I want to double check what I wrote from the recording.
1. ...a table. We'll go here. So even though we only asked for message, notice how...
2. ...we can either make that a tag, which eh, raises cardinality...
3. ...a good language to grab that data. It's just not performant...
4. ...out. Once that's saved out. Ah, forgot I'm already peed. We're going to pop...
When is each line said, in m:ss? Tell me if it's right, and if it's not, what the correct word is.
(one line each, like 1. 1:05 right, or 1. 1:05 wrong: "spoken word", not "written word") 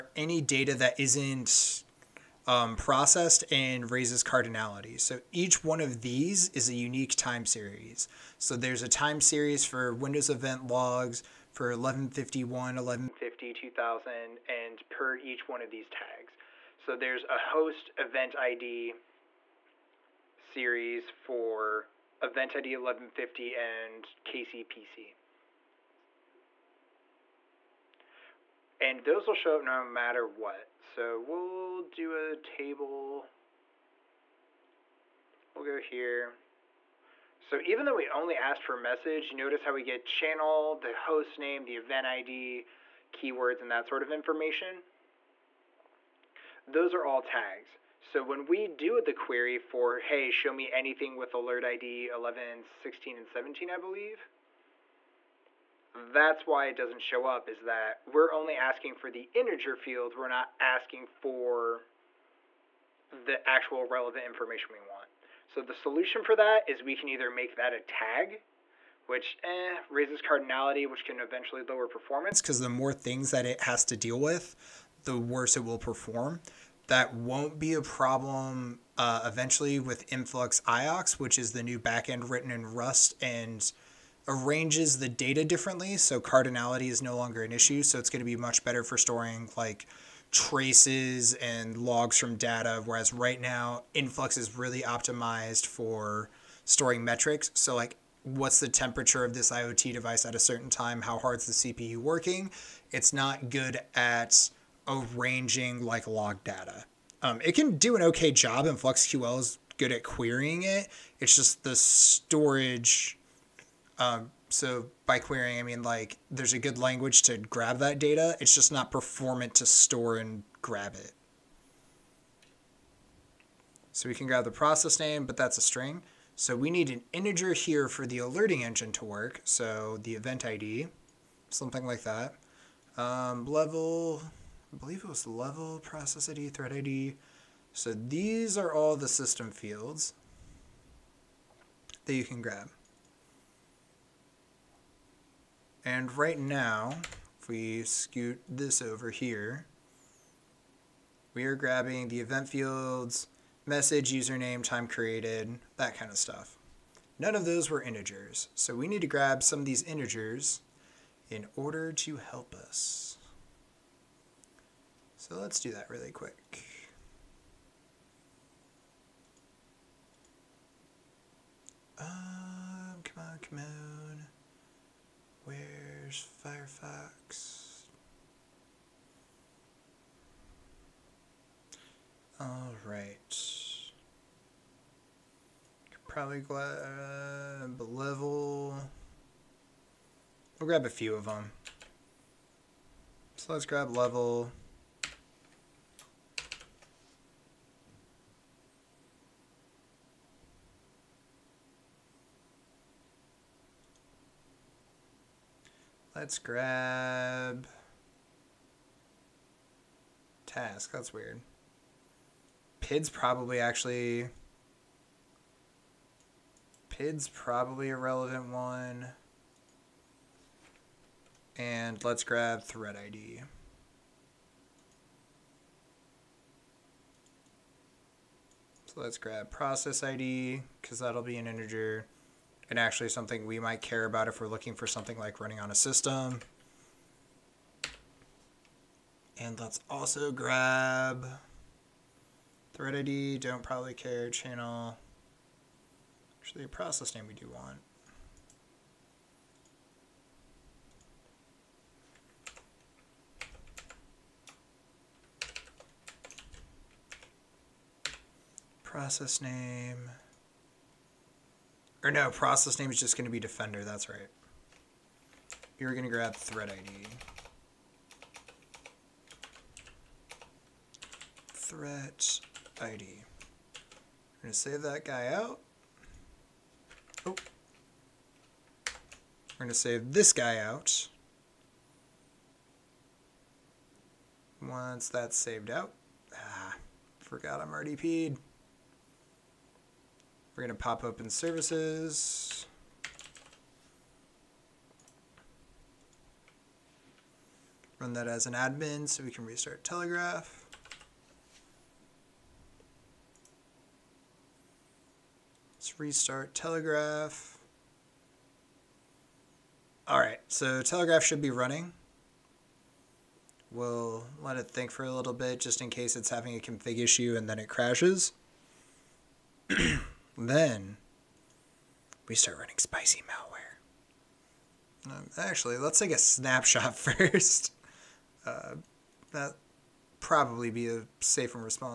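1. 0:32 right
2. 1:06 right
3. 1:56 right
4. 4:40 right.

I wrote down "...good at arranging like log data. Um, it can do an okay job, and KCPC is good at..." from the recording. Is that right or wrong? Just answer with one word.
wrong.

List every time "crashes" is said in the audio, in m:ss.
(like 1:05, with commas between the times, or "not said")
5:17.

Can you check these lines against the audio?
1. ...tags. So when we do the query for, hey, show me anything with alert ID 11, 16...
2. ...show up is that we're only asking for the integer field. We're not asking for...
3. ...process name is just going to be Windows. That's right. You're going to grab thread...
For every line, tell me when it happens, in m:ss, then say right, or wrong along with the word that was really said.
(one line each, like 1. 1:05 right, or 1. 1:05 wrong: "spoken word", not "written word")
1. 0:47 right
2. 0:57 right
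3. 4:22 wrong: "Defender", not "Windows".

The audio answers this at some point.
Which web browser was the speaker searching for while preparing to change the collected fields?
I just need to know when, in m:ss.
2:56.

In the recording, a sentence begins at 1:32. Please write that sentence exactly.
Whereas right now, Influx is really optimized for storing metrics.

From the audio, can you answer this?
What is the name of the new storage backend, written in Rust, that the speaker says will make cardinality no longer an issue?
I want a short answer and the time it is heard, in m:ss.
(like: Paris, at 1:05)
Influx IOX, at 1:20.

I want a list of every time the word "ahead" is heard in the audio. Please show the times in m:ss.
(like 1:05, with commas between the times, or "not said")
not said.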